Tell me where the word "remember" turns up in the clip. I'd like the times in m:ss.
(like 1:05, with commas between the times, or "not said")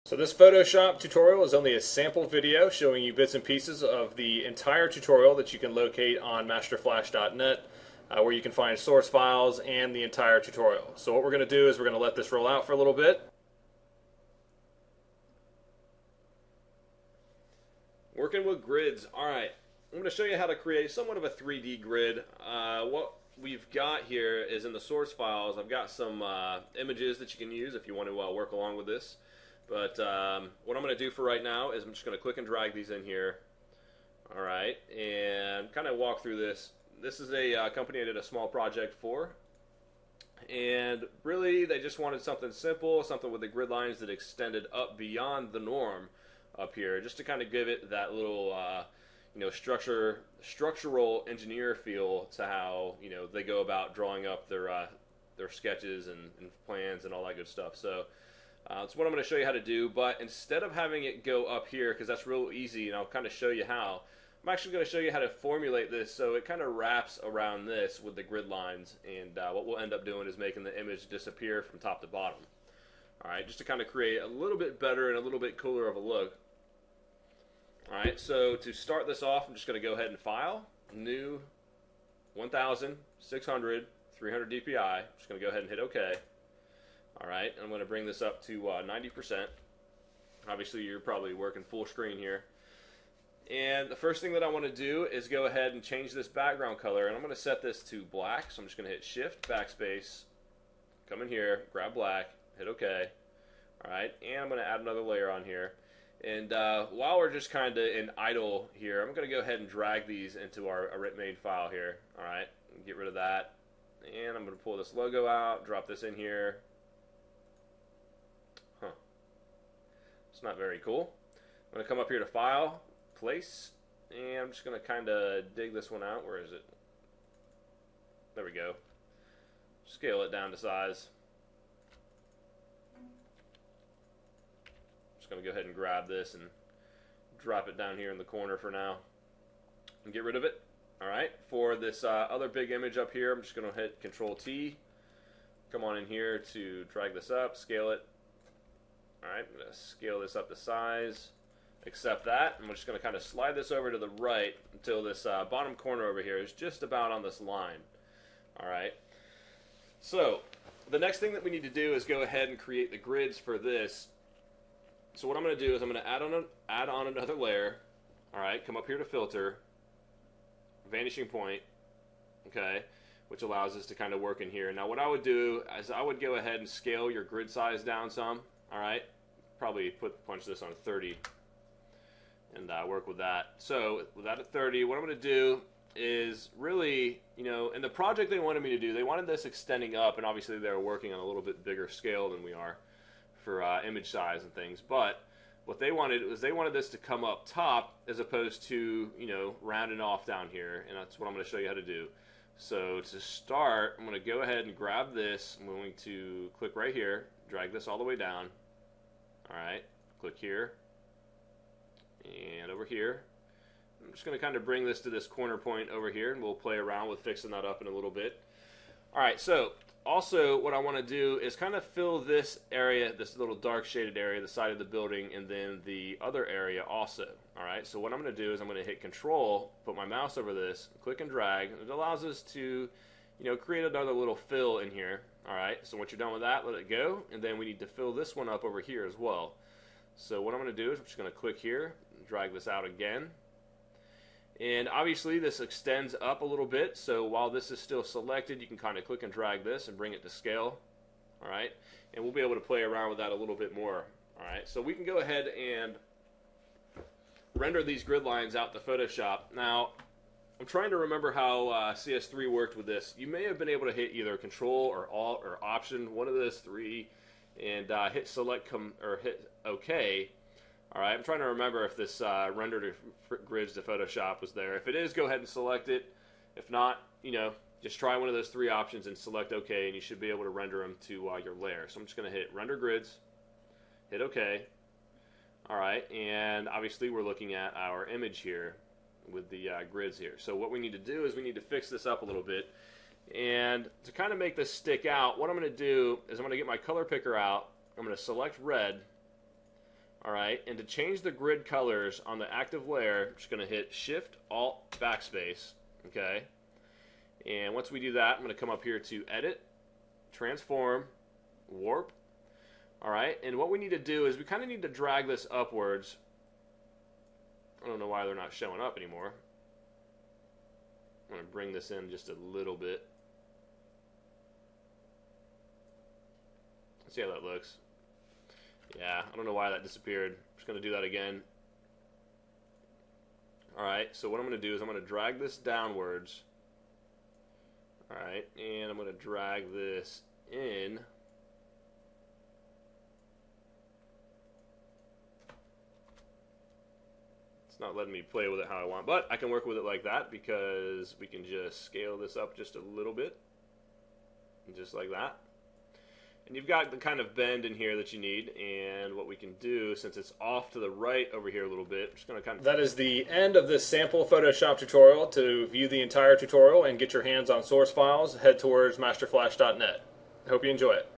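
4:20, 4:31.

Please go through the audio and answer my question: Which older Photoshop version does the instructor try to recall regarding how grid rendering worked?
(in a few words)
CS3.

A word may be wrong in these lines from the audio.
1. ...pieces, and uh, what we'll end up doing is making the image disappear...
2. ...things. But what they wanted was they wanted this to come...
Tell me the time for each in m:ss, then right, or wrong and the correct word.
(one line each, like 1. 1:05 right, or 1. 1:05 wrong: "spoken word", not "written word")
1. 1:08 wrong: "lines", not "pieces"
2. 3:14 right.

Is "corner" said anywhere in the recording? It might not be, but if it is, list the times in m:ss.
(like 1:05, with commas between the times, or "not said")
2:18, 2:35, 3:35.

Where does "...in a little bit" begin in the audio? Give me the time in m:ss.
3:37.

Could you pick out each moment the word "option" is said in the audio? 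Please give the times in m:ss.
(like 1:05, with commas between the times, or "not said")
4:25, 4:38.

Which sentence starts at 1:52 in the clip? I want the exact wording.
All right, get rid of that.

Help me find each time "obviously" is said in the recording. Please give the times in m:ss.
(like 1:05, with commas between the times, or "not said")
1:30, 3:10, 4:04, 4:46.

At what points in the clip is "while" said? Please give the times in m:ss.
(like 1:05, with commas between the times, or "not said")
1:46, 4:07.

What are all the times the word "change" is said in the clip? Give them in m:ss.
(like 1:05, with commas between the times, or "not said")
1:35, 5:00.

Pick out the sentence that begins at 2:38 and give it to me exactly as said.
Alright, so the next thing that we need to do is go ahead and create the grids for this.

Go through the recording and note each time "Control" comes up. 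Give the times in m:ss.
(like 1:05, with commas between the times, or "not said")
2:24, 3:49, 4:24.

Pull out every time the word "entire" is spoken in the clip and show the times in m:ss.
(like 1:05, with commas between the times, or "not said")
0:04, 0:10, 6:06.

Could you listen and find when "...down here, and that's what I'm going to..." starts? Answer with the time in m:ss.
3:20.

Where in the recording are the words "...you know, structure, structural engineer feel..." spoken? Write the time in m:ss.
0:49.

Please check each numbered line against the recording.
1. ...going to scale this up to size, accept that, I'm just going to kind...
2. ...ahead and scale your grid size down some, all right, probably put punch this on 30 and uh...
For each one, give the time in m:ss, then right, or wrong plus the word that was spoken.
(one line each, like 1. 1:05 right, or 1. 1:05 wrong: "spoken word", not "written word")
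1. 2:29 right
2. 2:56 right.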